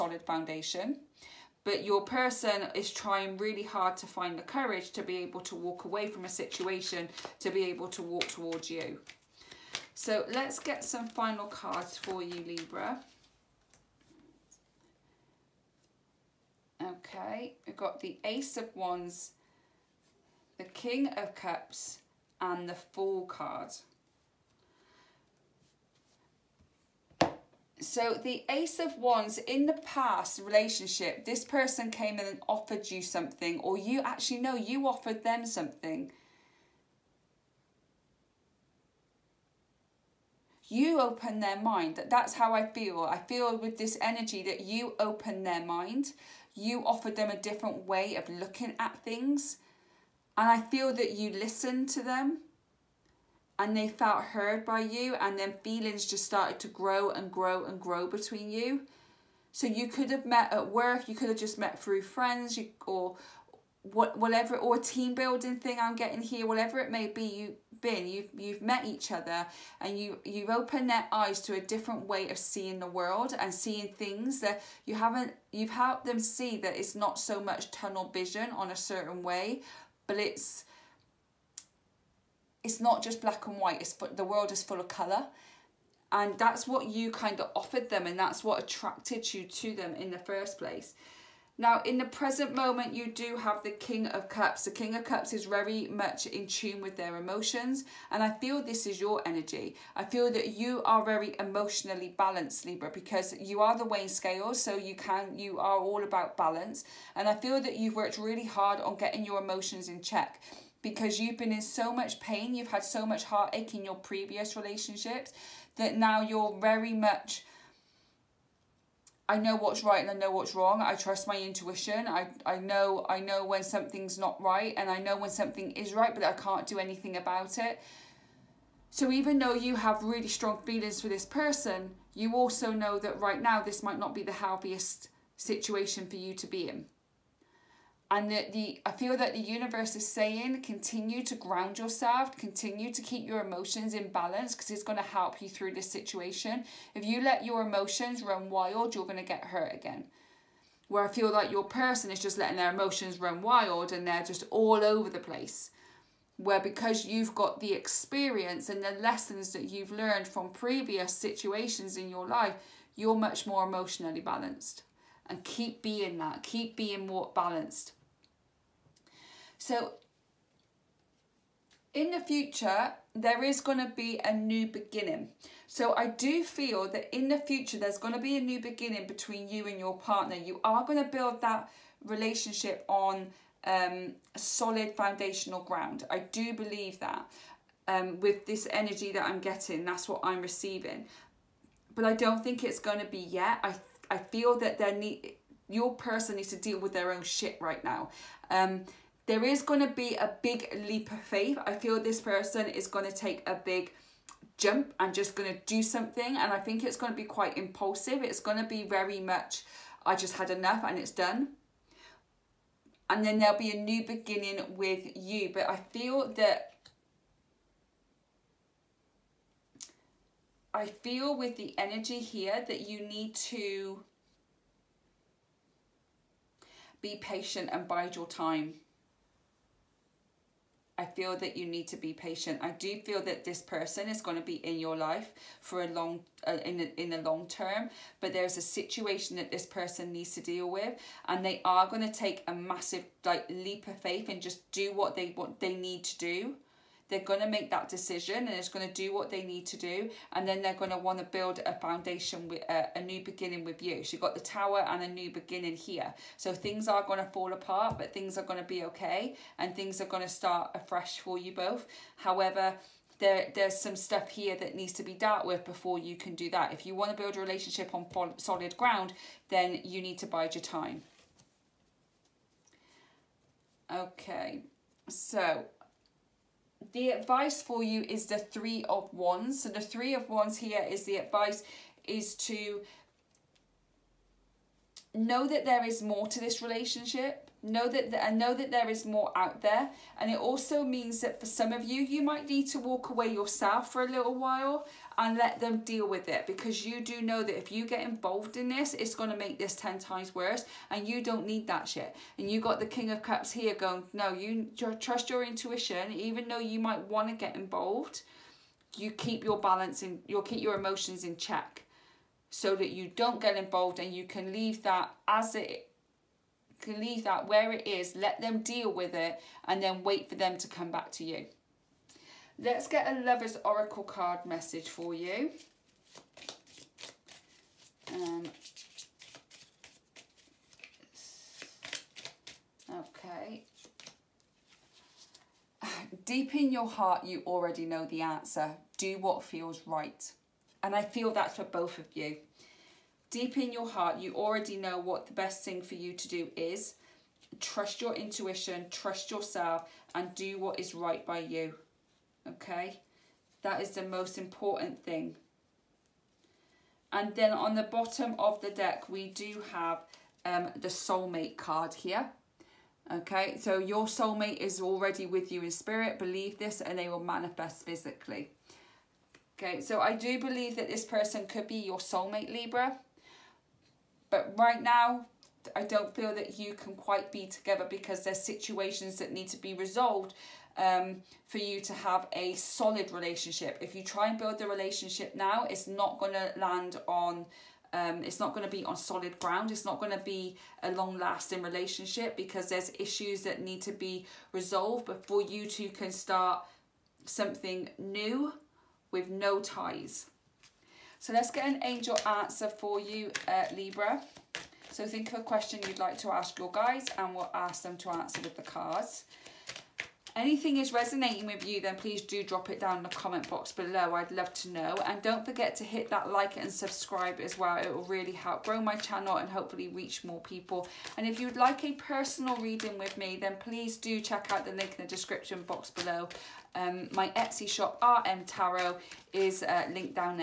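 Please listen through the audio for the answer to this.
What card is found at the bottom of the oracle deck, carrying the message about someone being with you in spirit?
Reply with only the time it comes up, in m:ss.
6:00.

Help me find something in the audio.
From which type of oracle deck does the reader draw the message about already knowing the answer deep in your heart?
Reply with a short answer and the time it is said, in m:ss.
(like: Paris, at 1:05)
Lover's Oracle, at 5:23.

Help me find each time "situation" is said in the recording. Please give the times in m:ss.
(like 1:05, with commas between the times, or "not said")
0:06, 2:15, 2:25, 2:41, 3:58, 6:18.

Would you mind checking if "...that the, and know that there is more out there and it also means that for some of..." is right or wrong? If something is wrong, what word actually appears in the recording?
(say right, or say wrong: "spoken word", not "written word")
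right.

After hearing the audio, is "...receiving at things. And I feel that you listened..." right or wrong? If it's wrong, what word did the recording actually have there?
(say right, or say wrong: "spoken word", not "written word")
wrong: "looking", not "receiving".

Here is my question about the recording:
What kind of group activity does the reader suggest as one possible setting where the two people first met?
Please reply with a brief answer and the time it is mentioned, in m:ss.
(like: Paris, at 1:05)
team building, at 1:04.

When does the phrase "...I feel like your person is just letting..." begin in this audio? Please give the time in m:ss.
2:31.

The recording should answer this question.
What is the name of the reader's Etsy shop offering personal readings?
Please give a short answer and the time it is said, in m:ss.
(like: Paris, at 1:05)
RM Tarot, at 7:08.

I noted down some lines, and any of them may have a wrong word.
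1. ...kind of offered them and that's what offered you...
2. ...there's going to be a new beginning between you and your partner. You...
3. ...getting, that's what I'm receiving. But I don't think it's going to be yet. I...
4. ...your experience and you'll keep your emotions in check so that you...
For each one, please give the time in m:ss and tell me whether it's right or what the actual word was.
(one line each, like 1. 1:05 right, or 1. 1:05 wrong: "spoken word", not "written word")
1. 1:27 wrong: "attracted", not "offered"
2. 2:57 right
3. 3:09 right
4. 5:09 wrong: "balance", not "experience".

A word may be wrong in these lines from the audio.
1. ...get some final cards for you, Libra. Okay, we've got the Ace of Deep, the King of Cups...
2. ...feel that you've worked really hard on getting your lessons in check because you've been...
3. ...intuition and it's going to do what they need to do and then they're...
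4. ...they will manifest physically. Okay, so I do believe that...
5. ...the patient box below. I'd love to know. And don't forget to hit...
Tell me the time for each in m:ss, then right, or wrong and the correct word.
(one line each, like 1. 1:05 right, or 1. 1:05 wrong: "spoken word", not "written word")
1. 0:10 wrong: "Wands", not "Deep"
2. 1:47 wrong: "emotions", not "lessons"
3. 4:07 wrong: "decision", not "intuition"
4. 6:06 right
5. 6:53 wrong: "comment", not "patient".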